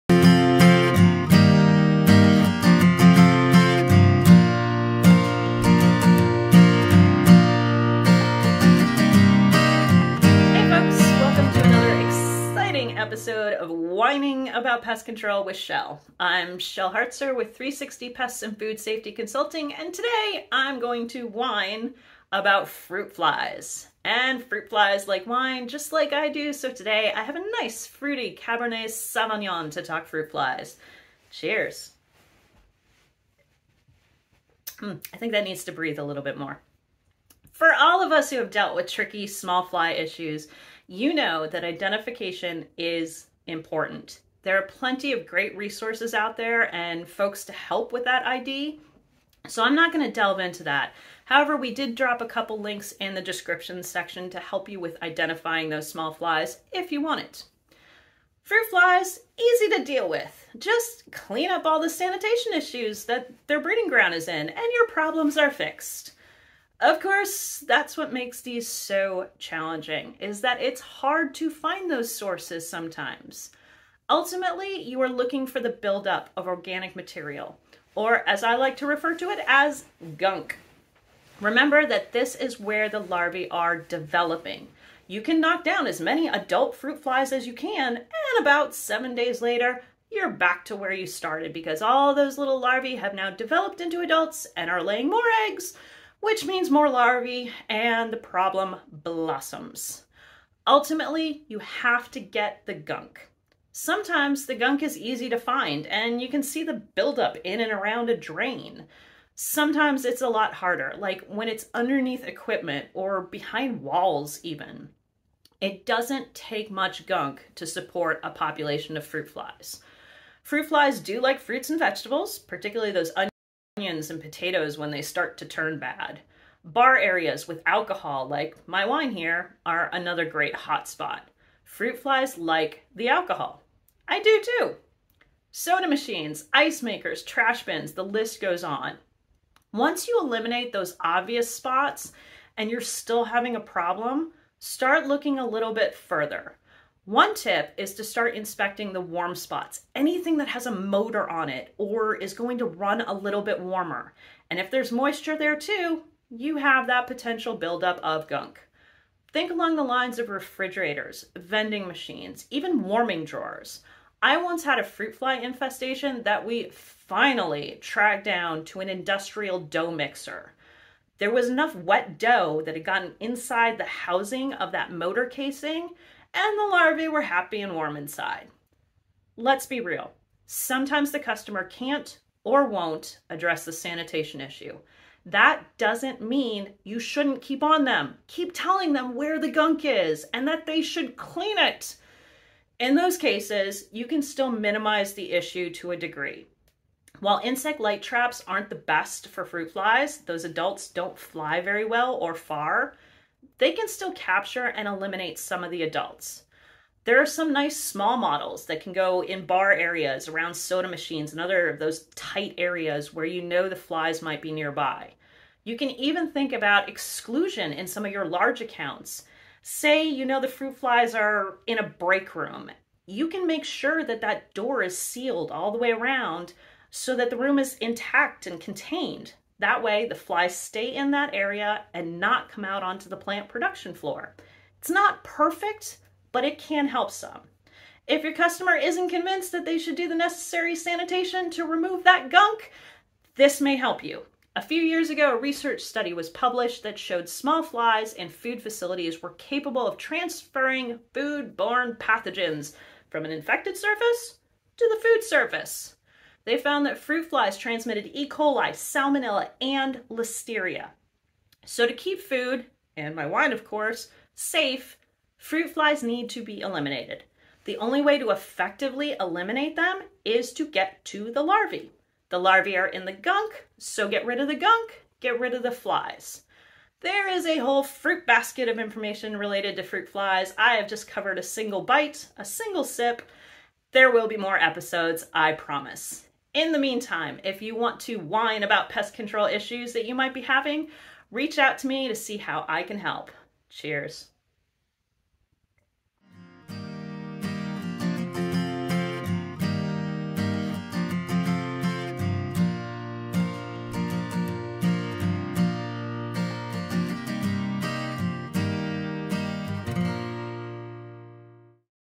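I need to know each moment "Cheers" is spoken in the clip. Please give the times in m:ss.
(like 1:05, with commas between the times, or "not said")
0:31, 4:53.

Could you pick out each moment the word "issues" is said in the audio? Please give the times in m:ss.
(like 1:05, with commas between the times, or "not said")
0:39, 1:02, 3:04, 3:15, 4:49.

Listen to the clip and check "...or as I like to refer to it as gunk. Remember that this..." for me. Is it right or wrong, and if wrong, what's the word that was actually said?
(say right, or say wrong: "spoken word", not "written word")
right.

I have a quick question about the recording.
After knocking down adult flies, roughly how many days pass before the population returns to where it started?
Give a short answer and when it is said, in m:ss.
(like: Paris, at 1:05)
7, at 1:28.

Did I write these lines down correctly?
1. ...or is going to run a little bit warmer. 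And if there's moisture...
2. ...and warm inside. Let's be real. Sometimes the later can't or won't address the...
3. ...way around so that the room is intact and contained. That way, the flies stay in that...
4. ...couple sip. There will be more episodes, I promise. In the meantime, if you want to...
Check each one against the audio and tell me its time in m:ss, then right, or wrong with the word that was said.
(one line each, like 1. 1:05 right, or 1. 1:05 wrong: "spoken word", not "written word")
1. 2:31 right
2. 2:57 wrong: "customer", not "later"
3. 3:45 right
4. 4:42 wrong: "single", not "couple".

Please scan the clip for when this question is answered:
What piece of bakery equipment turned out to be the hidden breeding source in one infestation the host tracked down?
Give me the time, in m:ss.
2:48.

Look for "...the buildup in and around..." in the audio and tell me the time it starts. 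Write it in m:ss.
1:46.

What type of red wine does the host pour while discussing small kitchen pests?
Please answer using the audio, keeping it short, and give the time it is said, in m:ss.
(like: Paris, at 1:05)
Cabernet Sauvignon, at 0:28.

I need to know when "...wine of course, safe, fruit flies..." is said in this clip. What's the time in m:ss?
4:23.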